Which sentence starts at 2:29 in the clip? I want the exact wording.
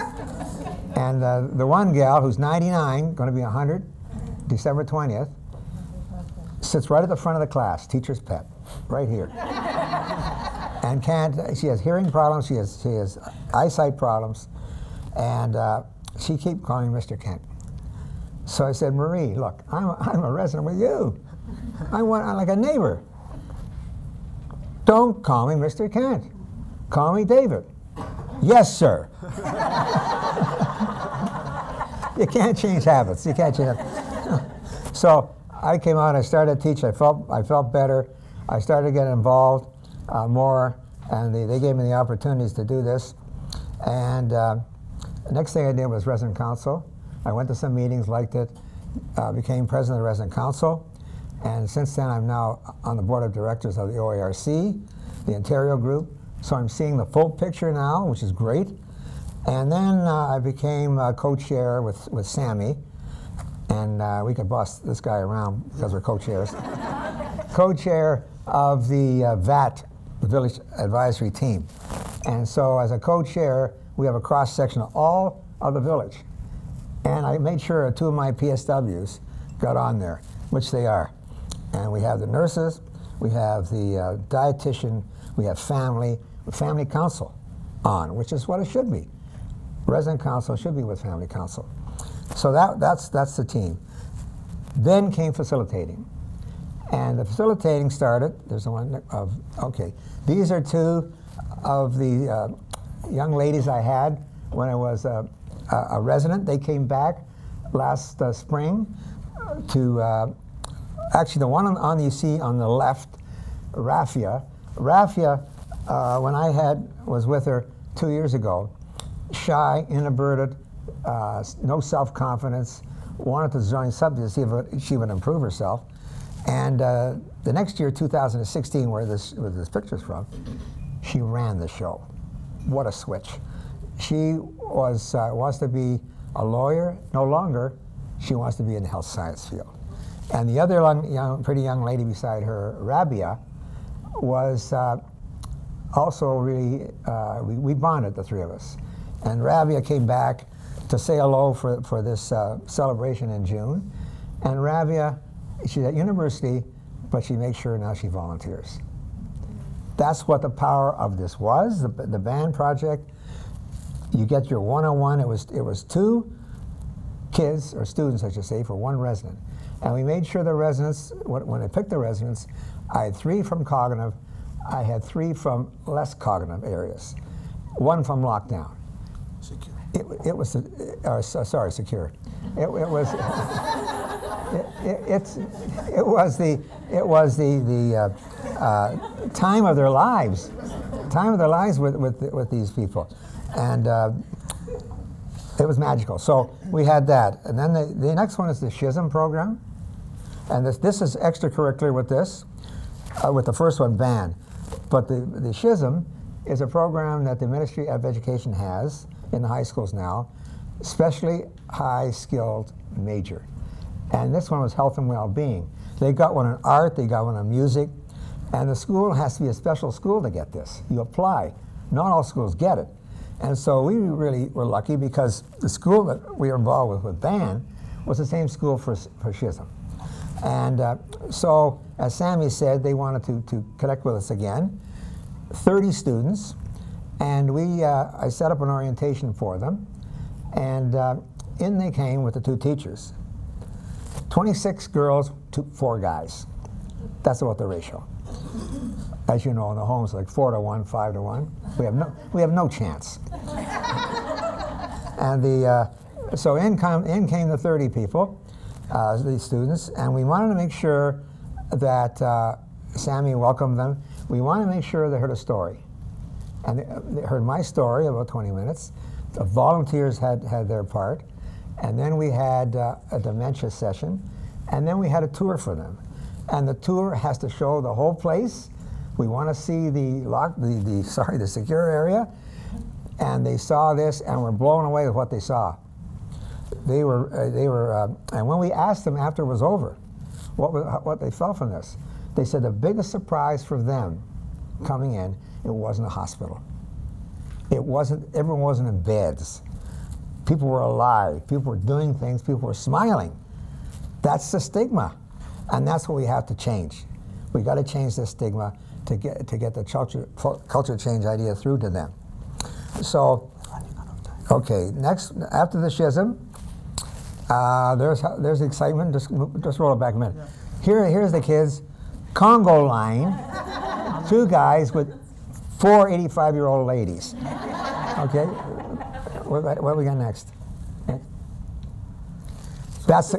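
And Rabia came back to say hello for, for this uh, celebration in June.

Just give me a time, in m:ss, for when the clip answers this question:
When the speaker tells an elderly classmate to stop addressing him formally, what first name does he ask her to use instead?
0:26.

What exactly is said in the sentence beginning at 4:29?
The volunteers had, had their part.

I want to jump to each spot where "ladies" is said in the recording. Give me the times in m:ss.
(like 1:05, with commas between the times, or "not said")
1:43, 5:26.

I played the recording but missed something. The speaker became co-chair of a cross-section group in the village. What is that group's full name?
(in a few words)
Village Advisory Team.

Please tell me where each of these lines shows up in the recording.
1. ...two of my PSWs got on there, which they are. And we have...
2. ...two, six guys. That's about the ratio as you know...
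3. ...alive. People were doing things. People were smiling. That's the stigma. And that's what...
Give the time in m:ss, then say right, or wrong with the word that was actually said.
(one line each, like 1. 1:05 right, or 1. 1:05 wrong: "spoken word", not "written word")
1. 1:17 right
2. 4:05 wrong: "four", not "six"
3. 5:00 right.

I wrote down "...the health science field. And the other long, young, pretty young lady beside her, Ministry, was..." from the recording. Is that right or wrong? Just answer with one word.
wrong.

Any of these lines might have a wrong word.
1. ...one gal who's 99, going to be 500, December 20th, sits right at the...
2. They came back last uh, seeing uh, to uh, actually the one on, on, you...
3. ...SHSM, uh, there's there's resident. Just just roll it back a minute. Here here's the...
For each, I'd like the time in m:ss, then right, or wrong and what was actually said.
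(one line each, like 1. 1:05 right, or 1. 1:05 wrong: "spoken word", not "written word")
1. 0:01 wrong: "100", not "500"
2. 1:46 wrong: "spring", not "seeing"
3. 5:15 wrong: "excitement", not "resident".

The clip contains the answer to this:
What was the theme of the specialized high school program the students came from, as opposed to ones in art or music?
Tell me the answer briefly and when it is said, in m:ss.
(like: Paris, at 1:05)
health and well being, at 3:34.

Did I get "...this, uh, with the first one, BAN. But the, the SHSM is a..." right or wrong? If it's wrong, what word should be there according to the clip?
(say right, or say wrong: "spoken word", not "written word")
right.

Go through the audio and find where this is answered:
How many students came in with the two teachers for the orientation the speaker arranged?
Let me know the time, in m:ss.
3:55.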